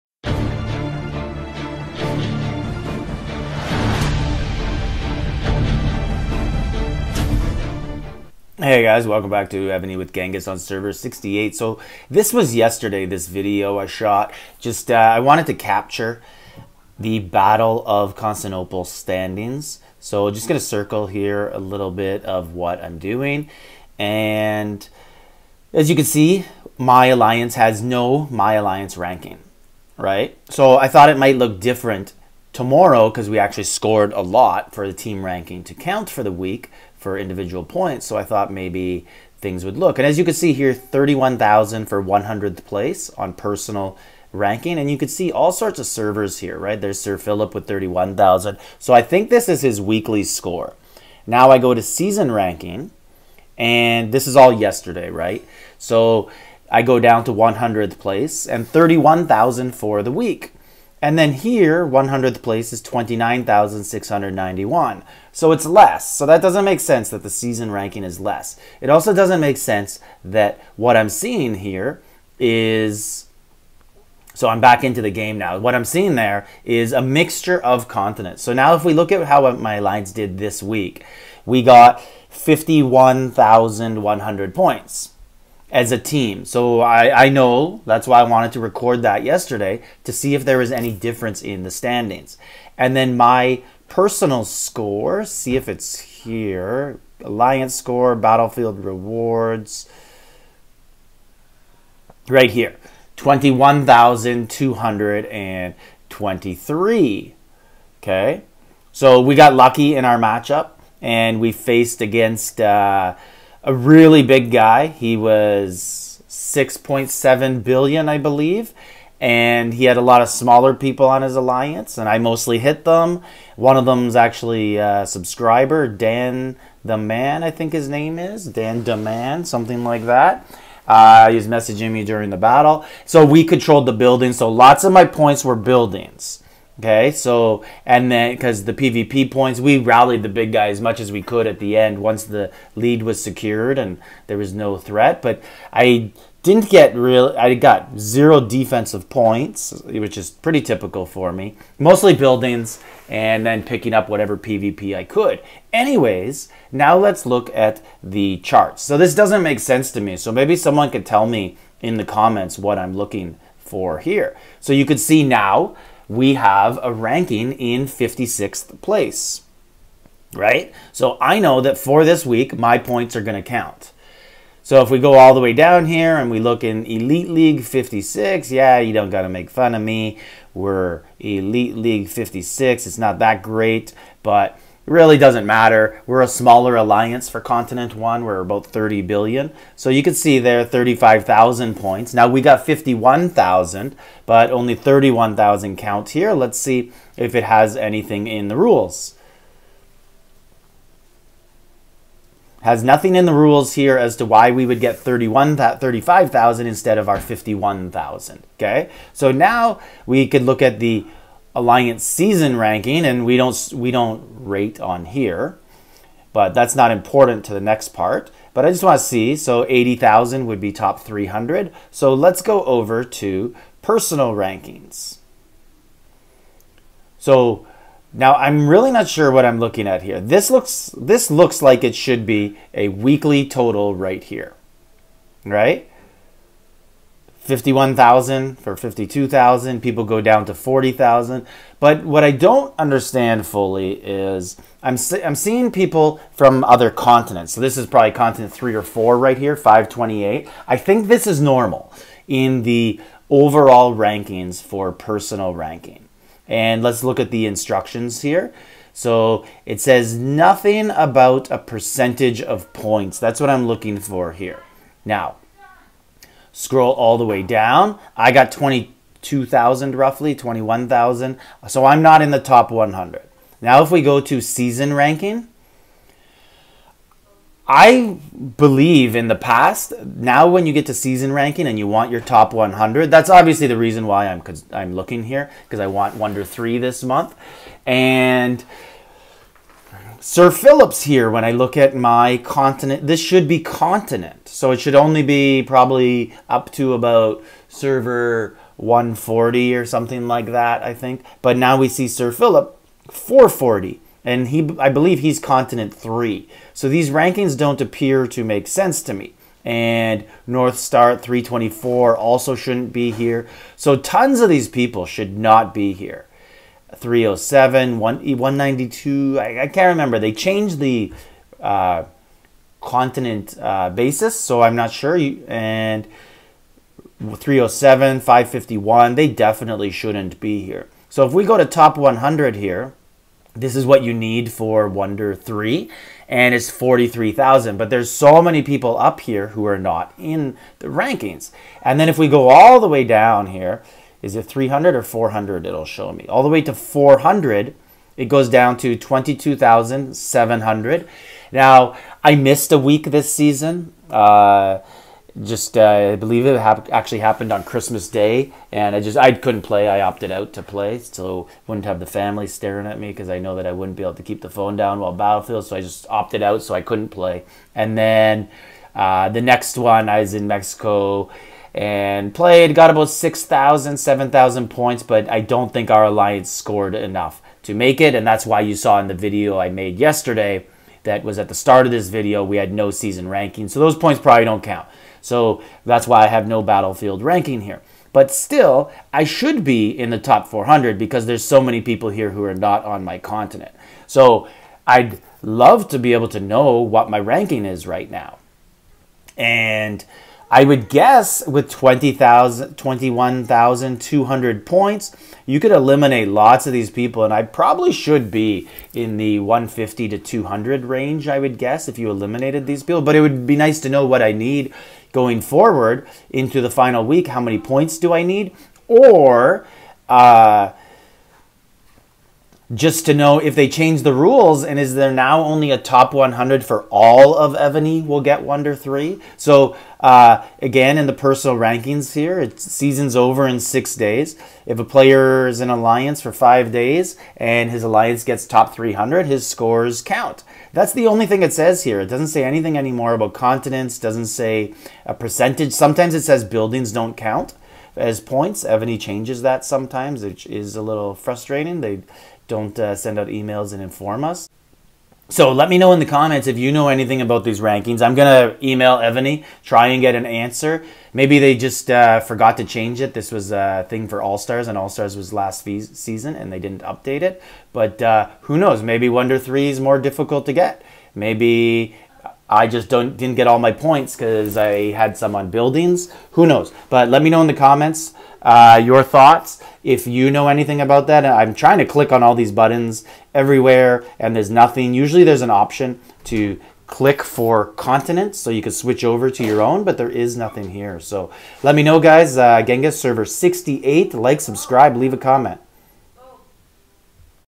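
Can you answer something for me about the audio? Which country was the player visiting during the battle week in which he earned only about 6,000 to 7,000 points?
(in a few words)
Mexico.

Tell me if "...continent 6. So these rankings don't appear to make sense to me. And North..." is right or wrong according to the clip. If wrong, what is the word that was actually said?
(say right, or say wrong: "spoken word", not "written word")
wrong: "3", not "6".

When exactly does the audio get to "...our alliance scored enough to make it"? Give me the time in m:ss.
6:15.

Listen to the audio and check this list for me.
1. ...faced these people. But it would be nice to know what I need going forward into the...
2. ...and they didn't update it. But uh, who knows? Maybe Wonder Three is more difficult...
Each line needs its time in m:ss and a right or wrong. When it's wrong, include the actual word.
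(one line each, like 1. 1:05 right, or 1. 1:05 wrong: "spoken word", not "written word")
1. 6:52 wrong: "eliminated", not "faced"
2. 7:46 right.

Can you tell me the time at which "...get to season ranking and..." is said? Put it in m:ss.
4:40.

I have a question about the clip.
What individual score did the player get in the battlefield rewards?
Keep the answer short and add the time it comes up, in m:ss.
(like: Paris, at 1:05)
21,223, at 1:43.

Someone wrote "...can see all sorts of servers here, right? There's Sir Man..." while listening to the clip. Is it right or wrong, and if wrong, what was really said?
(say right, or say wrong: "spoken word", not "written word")
wrong: "Philip", not "Man".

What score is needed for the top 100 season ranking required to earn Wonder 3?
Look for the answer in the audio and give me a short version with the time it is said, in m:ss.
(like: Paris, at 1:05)
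43,000, at 5:36.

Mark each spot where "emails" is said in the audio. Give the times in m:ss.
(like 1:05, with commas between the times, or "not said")
7:33, 7:38.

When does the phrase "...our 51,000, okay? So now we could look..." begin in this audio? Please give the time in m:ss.
3:27.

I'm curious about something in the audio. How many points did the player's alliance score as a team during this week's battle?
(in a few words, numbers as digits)
51,100.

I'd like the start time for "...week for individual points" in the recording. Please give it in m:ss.
0:36.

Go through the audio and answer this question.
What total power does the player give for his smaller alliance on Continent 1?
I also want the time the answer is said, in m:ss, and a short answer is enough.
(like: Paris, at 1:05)
30 billion, at 3:08.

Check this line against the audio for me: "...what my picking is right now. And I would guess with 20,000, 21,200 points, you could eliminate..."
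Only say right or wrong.
wrong.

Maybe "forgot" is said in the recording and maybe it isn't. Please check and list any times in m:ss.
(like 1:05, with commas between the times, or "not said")
7:42.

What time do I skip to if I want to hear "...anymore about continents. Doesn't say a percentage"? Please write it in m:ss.
7:22.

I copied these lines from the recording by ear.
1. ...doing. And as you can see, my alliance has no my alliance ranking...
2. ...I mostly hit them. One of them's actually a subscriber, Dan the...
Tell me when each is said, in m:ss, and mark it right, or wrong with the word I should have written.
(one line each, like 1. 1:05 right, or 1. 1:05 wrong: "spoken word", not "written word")
1. 0:22 right
2. 2:02 right.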